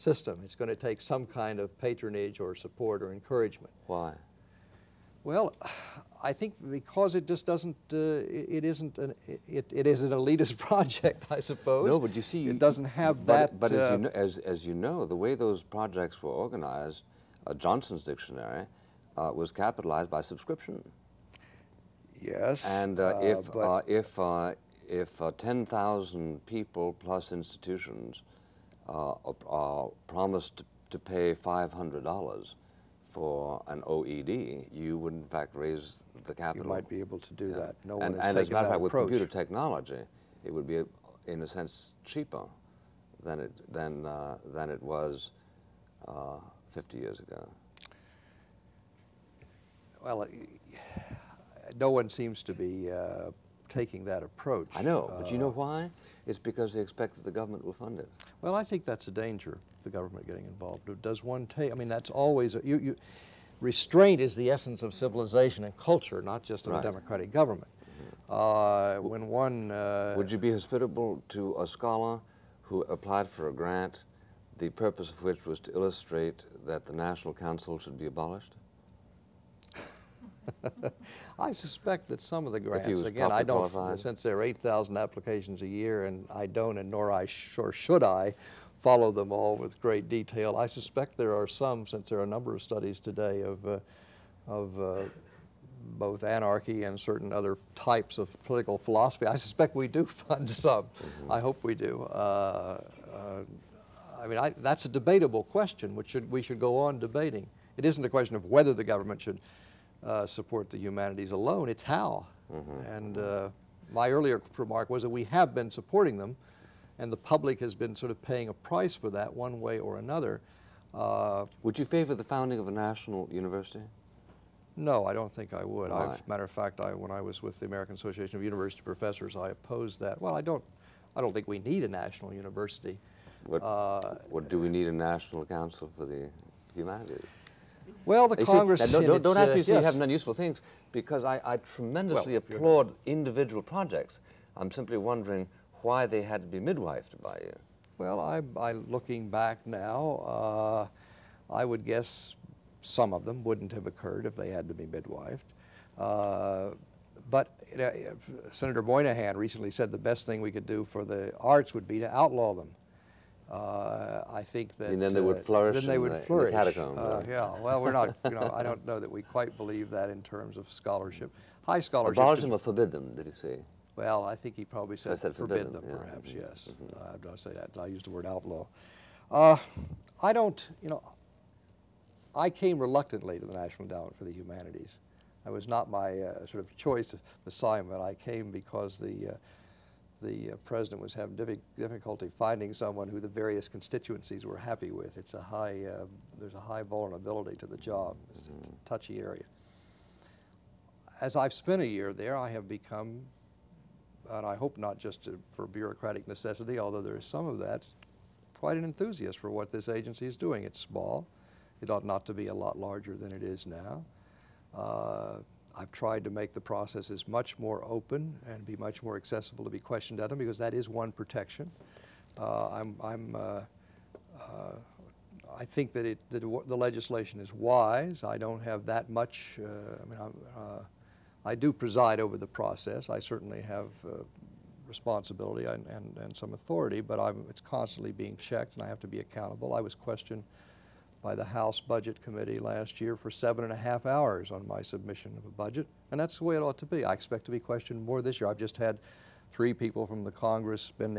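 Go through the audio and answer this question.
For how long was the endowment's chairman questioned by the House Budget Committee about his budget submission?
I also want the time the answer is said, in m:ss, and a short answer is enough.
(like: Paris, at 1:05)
7.5 hours, at 4:03.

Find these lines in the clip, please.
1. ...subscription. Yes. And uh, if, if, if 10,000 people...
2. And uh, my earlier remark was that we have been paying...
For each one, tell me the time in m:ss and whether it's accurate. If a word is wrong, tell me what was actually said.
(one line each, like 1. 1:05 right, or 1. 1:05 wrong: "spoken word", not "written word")
1. 0:20 right
2. 1:52 wrong: "supporting", not "paying".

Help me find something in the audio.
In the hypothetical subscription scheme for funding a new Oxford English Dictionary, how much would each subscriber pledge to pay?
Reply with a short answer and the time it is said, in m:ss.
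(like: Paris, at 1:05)
$500, at 0:31.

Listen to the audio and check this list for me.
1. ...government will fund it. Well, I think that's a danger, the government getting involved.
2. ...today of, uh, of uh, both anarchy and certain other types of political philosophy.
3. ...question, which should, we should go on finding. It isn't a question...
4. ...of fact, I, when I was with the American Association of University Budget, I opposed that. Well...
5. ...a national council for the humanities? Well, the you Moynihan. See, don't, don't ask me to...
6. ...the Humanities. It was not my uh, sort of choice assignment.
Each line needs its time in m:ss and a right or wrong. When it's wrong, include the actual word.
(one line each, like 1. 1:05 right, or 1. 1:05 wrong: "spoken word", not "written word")
1. 0:57 right
2. 1:32 right
3. 1:45 wrong: "debating", not "finding"
4. 2:06 wrong: "Professors", not "Budget"
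5. 2:14 wrong: "Congress", not "Moynihan"
6. 3:04 right.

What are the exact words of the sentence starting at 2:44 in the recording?
And then they uh, would flourish.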